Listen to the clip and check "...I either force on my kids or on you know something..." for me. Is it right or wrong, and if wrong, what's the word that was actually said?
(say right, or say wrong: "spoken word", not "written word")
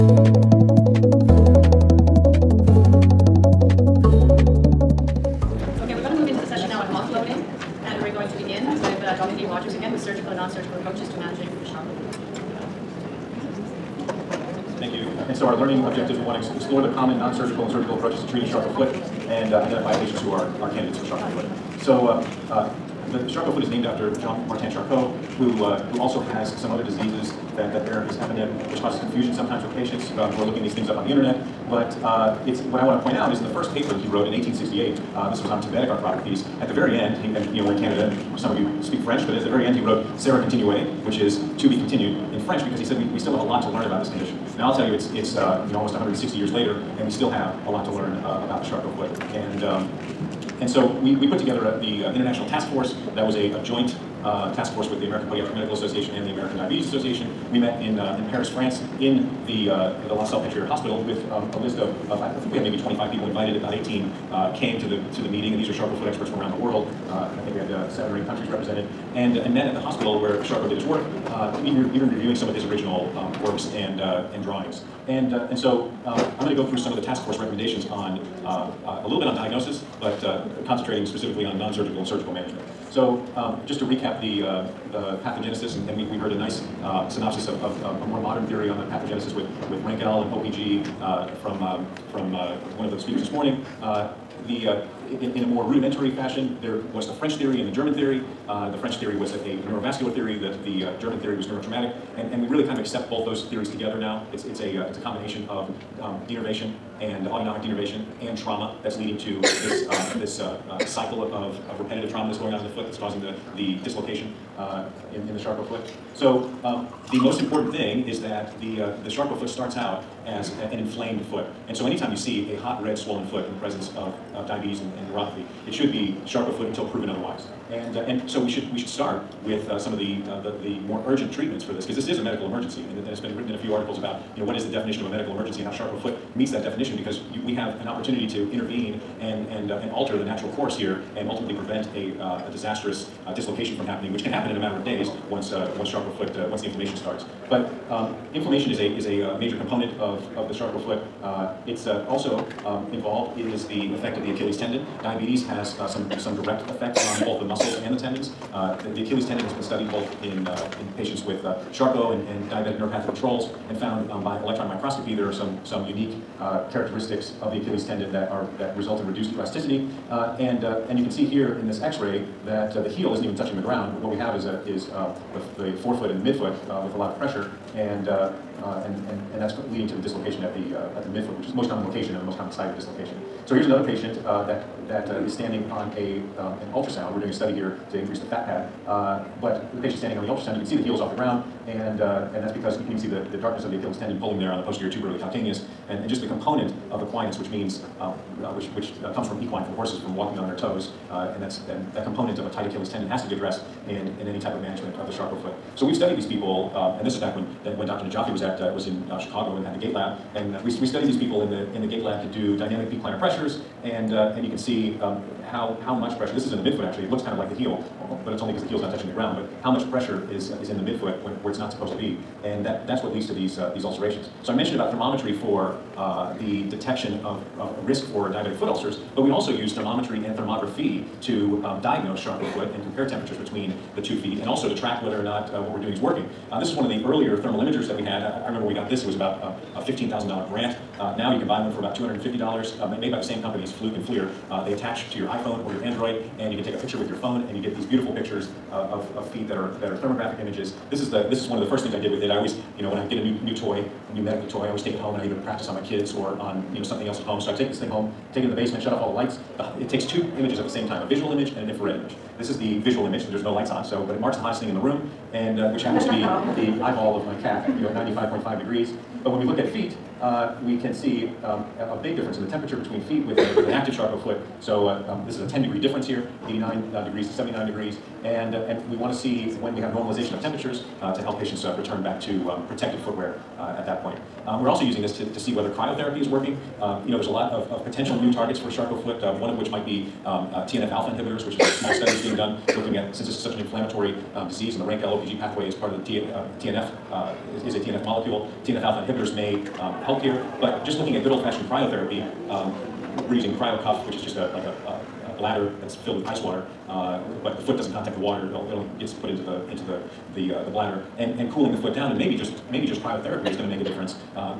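wrong: "practice", not "force".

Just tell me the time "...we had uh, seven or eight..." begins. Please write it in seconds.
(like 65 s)
67 s.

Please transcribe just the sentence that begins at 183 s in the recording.
So here's another patient uh, that, that is standing on a, um, an ultrasound.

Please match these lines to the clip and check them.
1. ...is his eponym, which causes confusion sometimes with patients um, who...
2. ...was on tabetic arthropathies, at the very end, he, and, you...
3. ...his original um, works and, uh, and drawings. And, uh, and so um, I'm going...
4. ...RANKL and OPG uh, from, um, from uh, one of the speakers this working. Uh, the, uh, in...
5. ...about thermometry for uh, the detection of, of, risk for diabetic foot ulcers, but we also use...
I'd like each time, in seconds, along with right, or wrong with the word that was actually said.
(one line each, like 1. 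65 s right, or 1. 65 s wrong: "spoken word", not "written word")
1. 28 s right
2. 35 s right
3. 72 s right
4. 89 s wrong: "morning", not "working"
5. 224 s right.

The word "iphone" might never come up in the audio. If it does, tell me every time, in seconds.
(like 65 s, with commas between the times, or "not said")
245 s.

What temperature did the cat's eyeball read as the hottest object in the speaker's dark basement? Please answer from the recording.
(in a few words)
95.5 degrees.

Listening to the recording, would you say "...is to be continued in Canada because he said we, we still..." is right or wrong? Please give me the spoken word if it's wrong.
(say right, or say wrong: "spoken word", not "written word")
wrong: "French", not "Canada".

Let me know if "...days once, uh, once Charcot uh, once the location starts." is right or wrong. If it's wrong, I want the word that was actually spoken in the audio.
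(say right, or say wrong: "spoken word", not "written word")
wrong: "inflammation", not "location".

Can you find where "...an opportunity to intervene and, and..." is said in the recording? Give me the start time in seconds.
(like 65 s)
137 s.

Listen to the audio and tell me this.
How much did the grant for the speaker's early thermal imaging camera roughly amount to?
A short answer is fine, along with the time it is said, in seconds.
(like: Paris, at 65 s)
$15,000, at 239 s.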